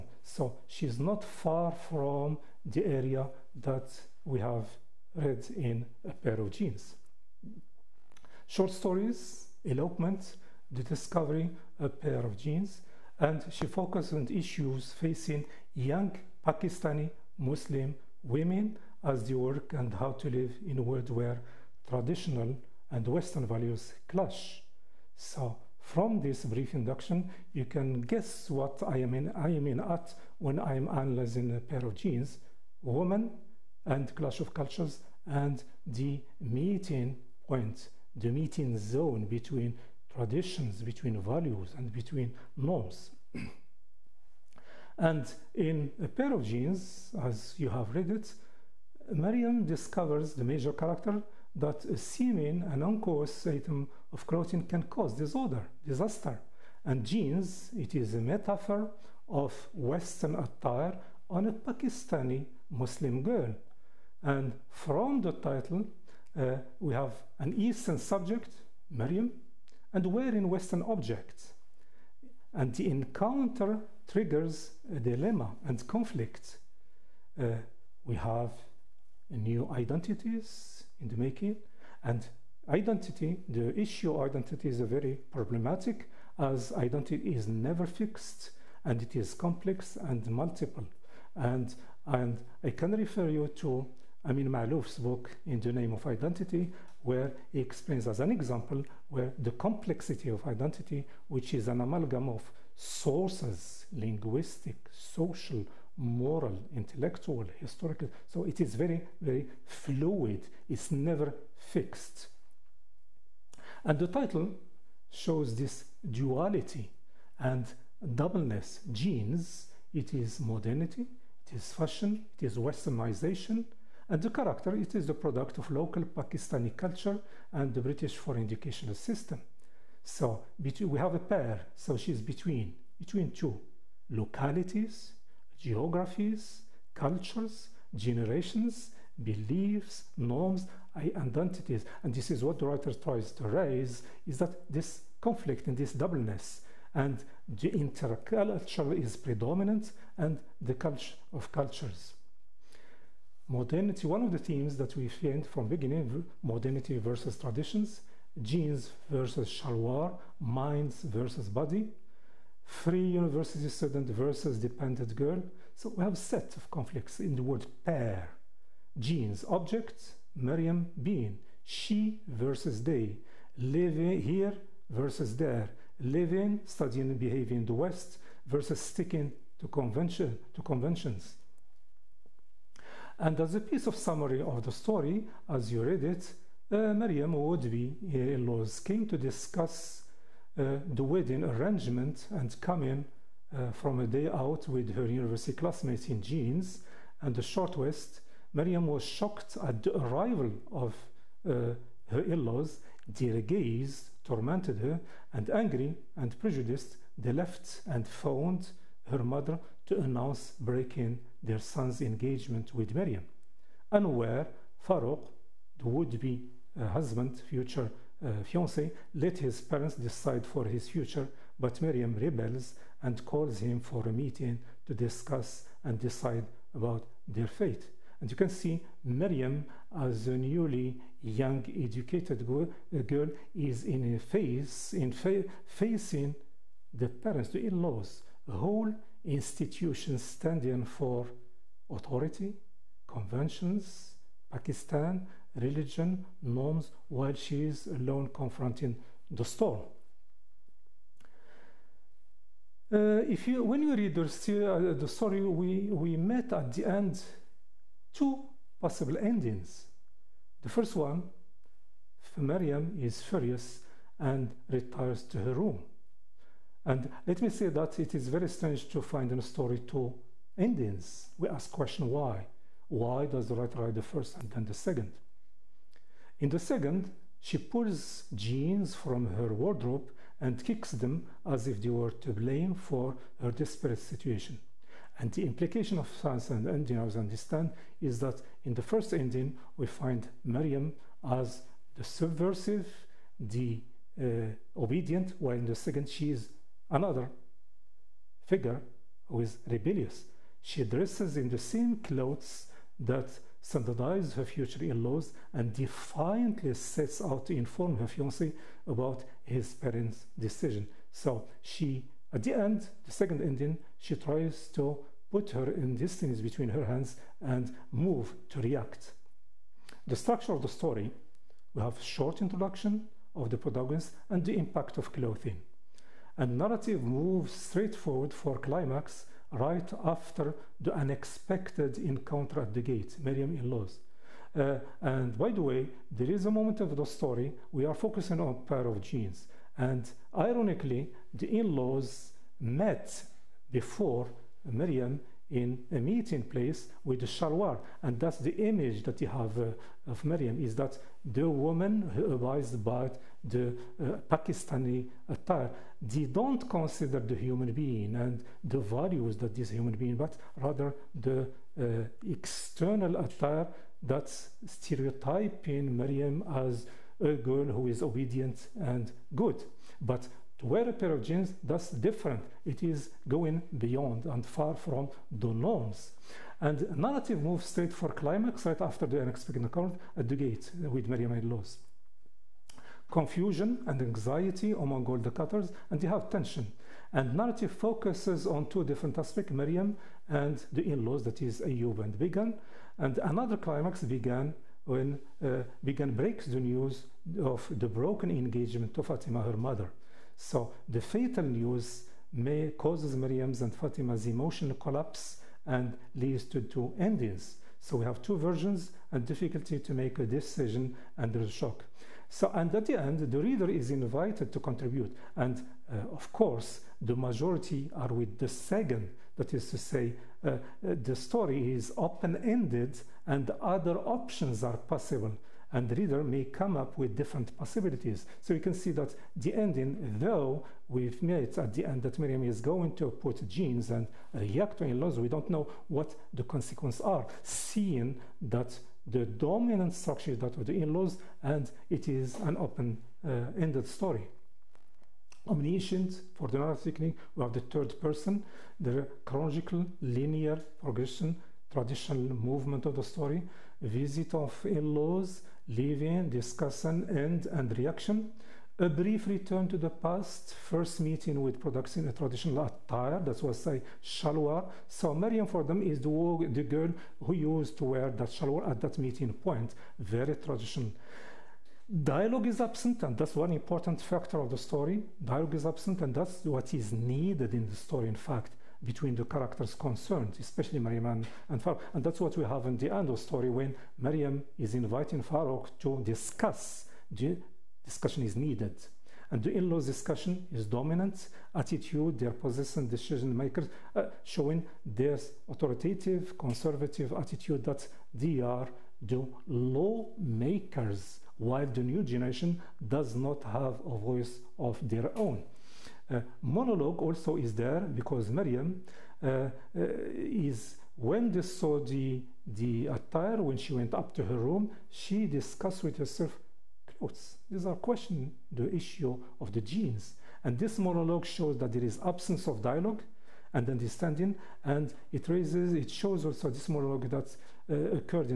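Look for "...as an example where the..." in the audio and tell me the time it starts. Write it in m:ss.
1:38.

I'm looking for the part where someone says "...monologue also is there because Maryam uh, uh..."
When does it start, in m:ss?
8:26.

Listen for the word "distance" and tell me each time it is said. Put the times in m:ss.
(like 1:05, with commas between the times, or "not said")
5:15.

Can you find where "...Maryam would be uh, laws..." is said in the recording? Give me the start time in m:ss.
3:06.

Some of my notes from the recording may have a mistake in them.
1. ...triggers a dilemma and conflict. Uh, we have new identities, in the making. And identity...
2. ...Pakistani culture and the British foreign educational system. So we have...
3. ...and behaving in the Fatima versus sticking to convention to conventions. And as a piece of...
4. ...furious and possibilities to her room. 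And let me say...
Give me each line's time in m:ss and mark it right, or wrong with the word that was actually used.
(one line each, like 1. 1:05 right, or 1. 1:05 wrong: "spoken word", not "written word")
1. 1:14 right
2. 2:06 right
3. 2:57 wrong: "West", not "Fatima"
4. 4:23 wrong: "retires", not "possibilities".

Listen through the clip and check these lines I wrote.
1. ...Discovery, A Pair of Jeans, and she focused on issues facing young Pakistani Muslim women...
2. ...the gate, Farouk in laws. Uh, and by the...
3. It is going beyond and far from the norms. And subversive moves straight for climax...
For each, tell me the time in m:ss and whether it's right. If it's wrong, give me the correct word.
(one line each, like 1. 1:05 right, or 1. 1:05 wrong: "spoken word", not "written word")
1. 0:10 right
2. 5:32 wrong: "Miriam", not "Farouk"
3. 6:12 wrong: "narrative", not "subversive".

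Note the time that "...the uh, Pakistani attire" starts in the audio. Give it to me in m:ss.
5:53.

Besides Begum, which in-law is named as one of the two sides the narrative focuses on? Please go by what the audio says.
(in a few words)
Ayub.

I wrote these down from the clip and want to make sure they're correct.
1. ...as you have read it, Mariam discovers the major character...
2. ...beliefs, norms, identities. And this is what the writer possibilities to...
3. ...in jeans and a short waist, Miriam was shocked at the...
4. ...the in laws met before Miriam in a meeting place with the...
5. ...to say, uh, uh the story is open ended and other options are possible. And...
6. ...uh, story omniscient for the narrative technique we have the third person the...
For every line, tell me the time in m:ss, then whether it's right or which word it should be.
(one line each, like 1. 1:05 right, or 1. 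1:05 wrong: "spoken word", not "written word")
1. 0:47 right
2. 2:19 wrong: "tries", not "possibilities"
3. 3:16 right
4. 5:41 right
5. 6:59 right
6. 7:23 right.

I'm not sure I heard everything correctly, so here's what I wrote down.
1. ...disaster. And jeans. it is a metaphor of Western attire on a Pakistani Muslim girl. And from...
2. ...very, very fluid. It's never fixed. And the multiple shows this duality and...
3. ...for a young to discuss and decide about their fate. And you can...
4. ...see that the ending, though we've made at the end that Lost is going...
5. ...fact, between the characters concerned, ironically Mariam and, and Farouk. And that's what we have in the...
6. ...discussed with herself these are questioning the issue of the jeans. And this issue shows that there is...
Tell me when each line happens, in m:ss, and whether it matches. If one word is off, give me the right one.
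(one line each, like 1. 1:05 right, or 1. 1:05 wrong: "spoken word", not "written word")
1. 0:55 right
2. 1:48 wrong: "title", not "multiple"
3. 3:43 wrong: "meeting", not "young"
4. 7:08 wrong: "Miriam", not "Lost"
5. 7:58 wrong: "especially", not "ironically"
6. 8:35 wrong: "monologue", not "issue".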